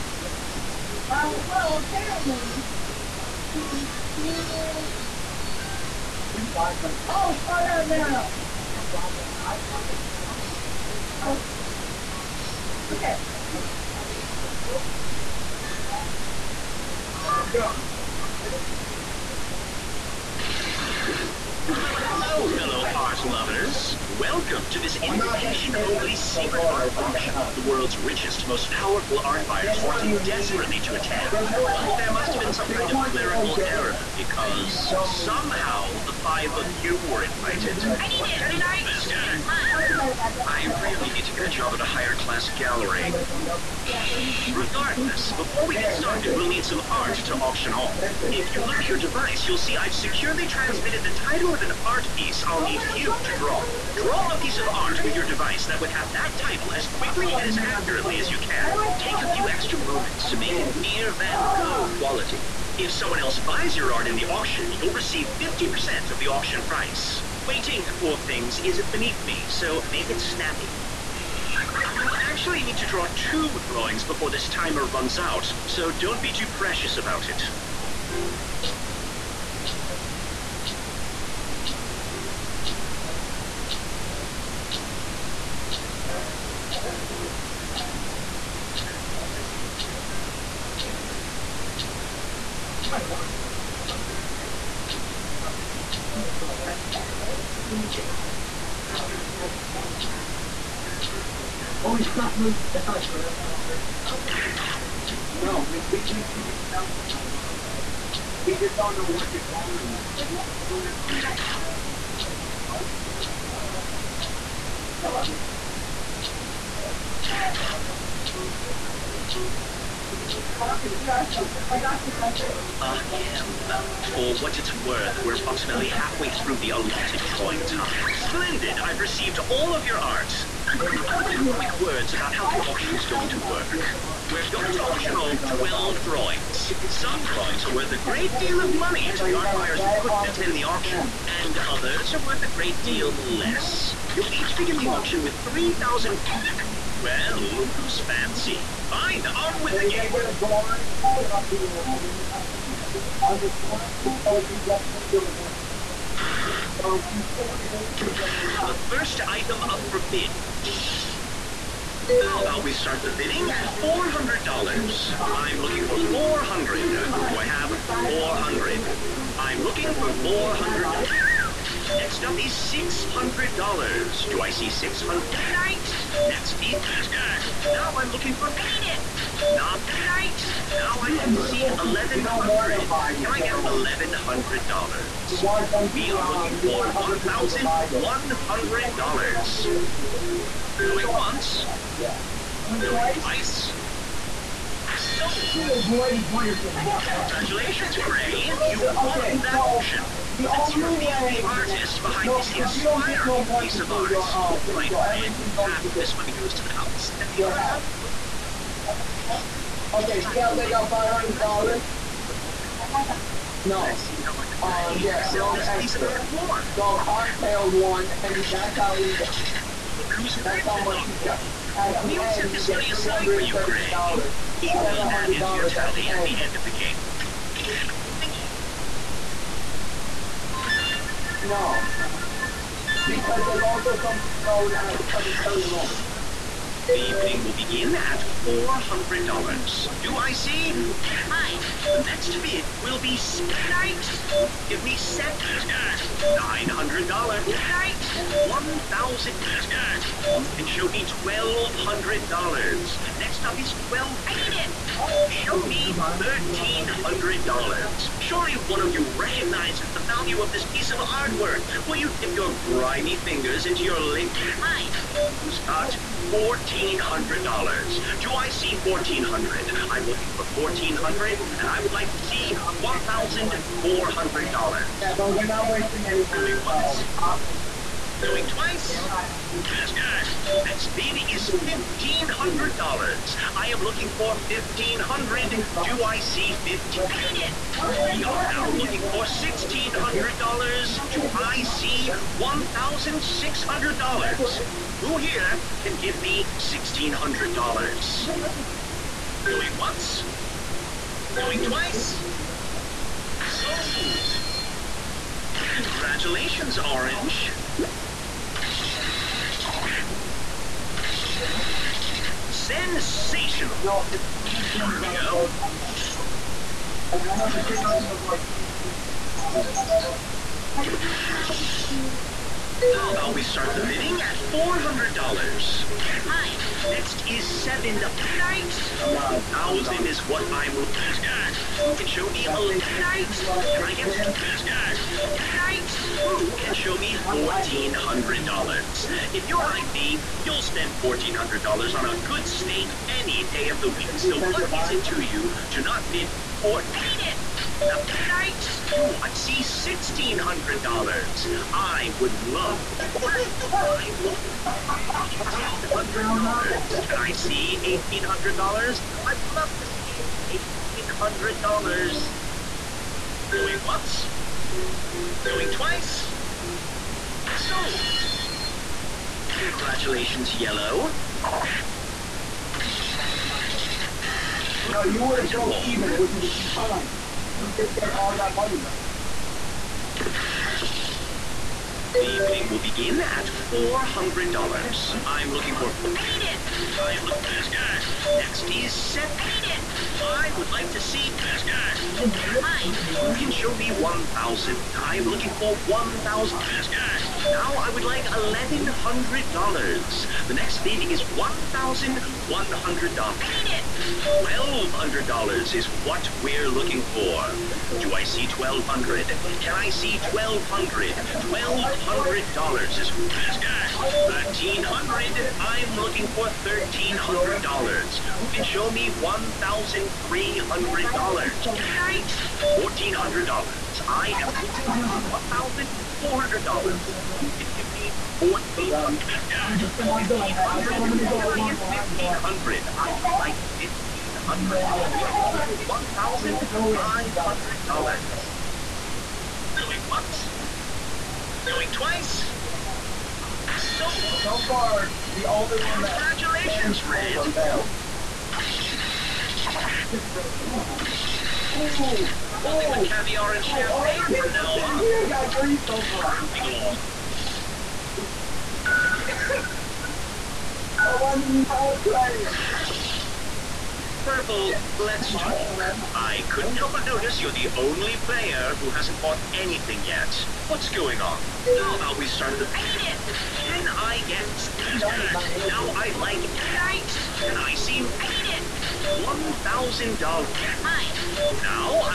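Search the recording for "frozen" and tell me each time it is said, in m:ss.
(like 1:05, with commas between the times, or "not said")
not said.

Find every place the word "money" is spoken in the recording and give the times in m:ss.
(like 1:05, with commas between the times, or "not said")
2:18, 3:26, 3:42, 6:18.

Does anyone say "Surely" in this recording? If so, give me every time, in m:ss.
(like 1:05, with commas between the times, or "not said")
4:18.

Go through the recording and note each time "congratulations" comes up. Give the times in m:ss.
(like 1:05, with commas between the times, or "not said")
3:16, 5:05, 6:09, 7:26.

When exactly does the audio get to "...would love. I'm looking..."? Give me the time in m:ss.
5:52.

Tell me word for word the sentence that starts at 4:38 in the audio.
This guy, That speed is fifteen hundred dollars.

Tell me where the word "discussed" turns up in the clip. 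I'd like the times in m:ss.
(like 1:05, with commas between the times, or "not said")
not said.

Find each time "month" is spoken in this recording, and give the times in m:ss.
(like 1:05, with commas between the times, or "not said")
5:15.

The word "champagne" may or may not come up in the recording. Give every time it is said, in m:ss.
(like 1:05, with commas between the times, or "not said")
7:33.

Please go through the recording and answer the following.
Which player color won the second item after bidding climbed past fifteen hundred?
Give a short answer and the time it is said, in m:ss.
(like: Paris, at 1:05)
Orange, at 5:06.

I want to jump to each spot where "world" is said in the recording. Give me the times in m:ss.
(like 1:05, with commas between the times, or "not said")
0:27.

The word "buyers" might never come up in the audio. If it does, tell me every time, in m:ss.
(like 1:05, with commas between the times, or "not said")
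0:29, 2:19.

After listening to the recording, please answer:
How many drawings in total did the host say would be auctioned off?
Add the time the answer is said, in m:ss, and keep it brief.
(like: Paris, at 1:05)
12, at 2:15.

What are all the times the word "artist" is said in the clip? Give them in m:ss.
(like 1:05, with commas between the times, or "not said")
3:21.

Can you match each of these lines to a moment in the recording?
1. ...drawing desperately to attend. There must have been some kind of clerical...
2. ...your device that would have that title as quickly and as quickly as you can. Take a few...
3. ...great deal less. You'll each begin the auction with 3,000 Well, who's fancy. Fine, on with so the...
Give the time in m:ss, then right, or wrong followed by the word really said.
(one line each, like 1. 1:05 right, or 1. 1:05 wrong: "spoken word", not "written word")
1. 0:29 wrong: "wanting", not "drawing"
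2. 0:55 wrong: "accurately", not "quickly"
3. 2:22 right.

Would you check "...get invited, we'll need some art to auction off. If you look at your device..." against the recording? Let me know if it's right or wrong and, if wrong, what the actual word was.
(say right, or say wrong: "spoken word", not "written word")
wrong: "started", not "invited".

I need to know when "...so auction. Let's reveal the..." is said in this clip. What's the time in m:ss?
3:19.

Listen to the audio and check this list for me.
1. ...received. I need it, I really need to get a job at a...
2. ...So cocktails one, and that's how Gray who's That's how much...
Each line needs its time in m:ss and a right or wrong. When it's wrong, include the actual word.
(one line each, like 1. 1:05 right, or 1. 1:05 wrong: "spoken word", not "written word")
1. 0:37 wrong: "invited", not "received"
2. 3:35 wrong: "Look", not "Gray".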